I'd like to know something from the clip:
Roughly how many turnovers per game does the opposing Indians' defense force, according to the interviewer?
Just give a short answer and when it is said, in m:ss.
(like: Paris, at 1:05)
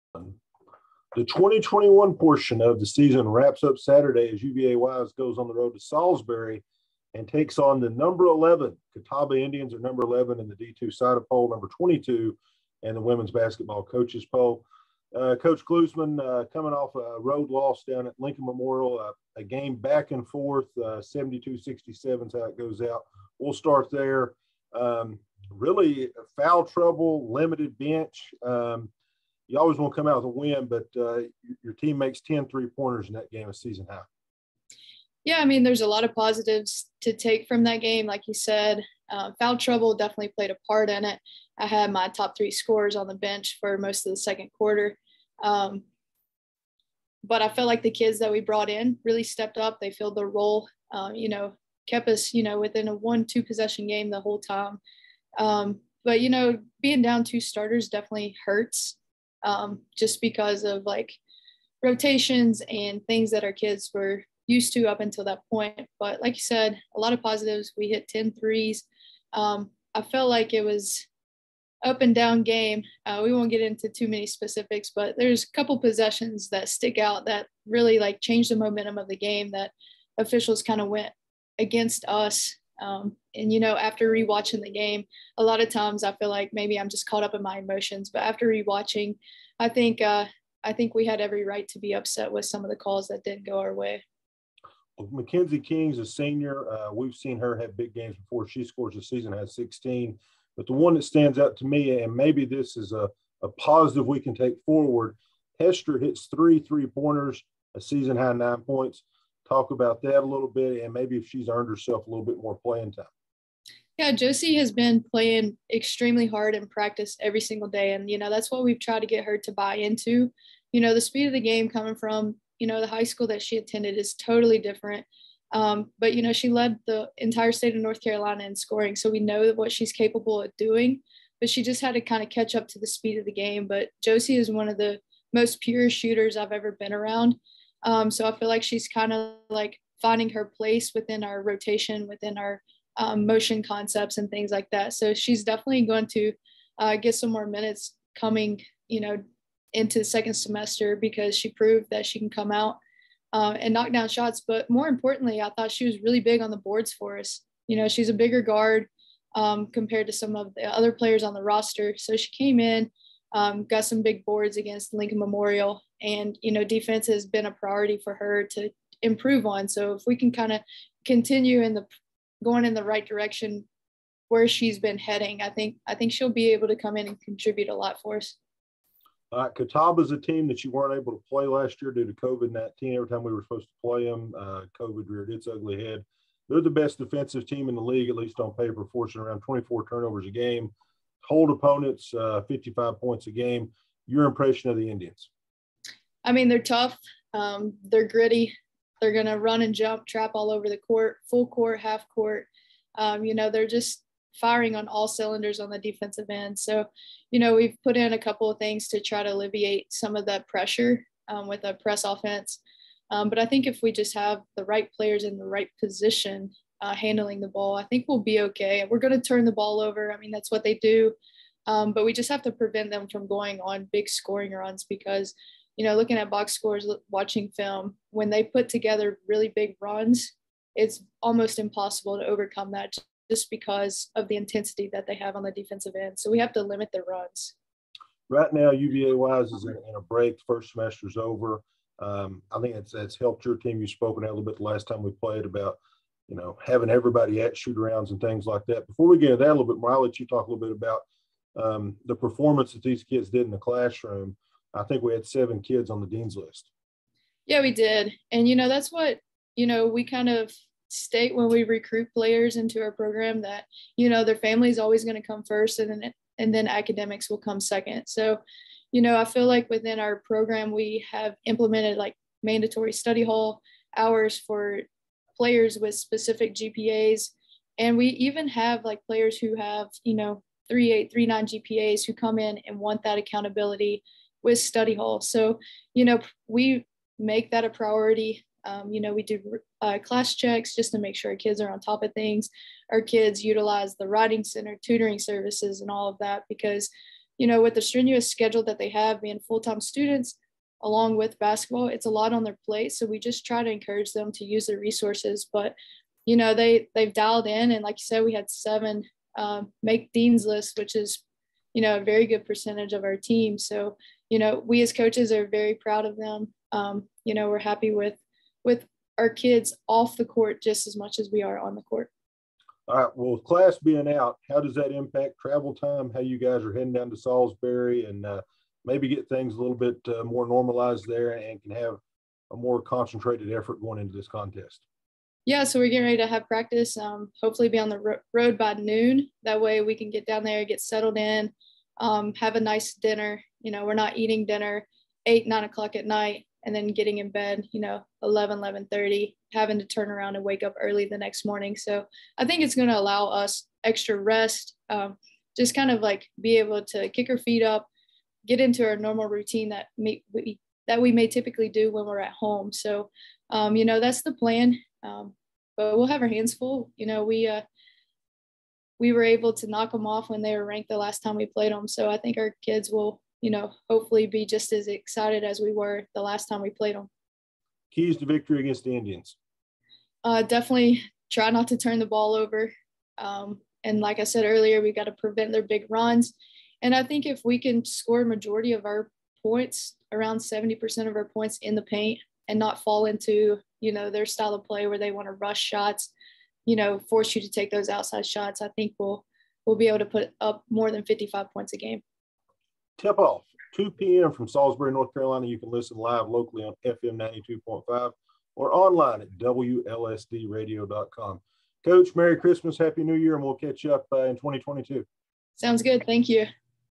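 24, at 3:09.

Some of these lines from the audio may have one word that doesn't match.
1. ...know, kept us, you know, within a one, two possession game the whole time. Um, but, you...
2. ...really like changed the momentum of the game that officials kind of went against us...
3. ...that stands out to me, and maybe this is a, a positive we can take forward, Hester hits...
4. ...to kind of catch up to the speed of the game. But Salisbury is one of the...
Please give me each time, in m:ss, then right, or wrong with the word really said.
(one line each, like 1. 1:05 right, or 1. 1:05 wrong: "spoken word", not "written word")
1. 0:51 right
2. 1:17 right
3. 1:40 right
4. 2:11 wrong: "Josie", not "Salisbury".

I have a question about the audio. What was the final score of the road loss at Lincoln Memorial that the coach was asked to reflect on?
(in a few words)
72-67.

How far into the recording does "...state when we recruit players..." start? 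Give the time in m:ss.
4:20.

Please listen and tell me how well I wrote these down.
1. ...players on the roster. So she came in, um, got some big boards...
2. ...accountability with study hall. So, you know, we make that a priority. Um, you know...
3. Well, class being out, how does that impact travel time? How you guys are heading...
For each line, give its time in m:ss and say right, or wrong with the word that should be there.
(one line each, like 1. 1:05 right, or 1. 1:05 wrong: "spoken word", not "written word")
1. 2:40 right
2. 4:43 right
3. 5:23 right.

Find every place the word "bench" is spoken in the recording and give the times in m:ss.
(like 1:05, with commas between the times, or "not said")
0:27, 0:43.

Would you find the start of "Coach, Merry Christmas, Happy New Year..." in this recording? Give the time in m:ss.
6:51.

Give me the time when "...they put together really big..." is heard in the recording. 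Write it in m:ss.
3:48.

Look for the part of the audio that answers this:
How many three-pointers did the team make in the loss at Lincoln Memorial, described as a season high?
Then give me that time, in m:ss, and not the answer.
0:32.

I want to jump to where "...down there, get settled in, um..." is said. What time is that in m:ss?
5:40.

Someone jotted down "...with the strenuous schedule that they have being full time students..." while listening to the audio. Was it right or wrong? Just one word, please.
right.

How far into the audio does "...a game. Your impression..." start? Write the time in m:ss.
3:13.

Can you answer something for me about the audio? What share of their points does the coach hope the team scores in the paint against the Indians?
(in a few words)
70%.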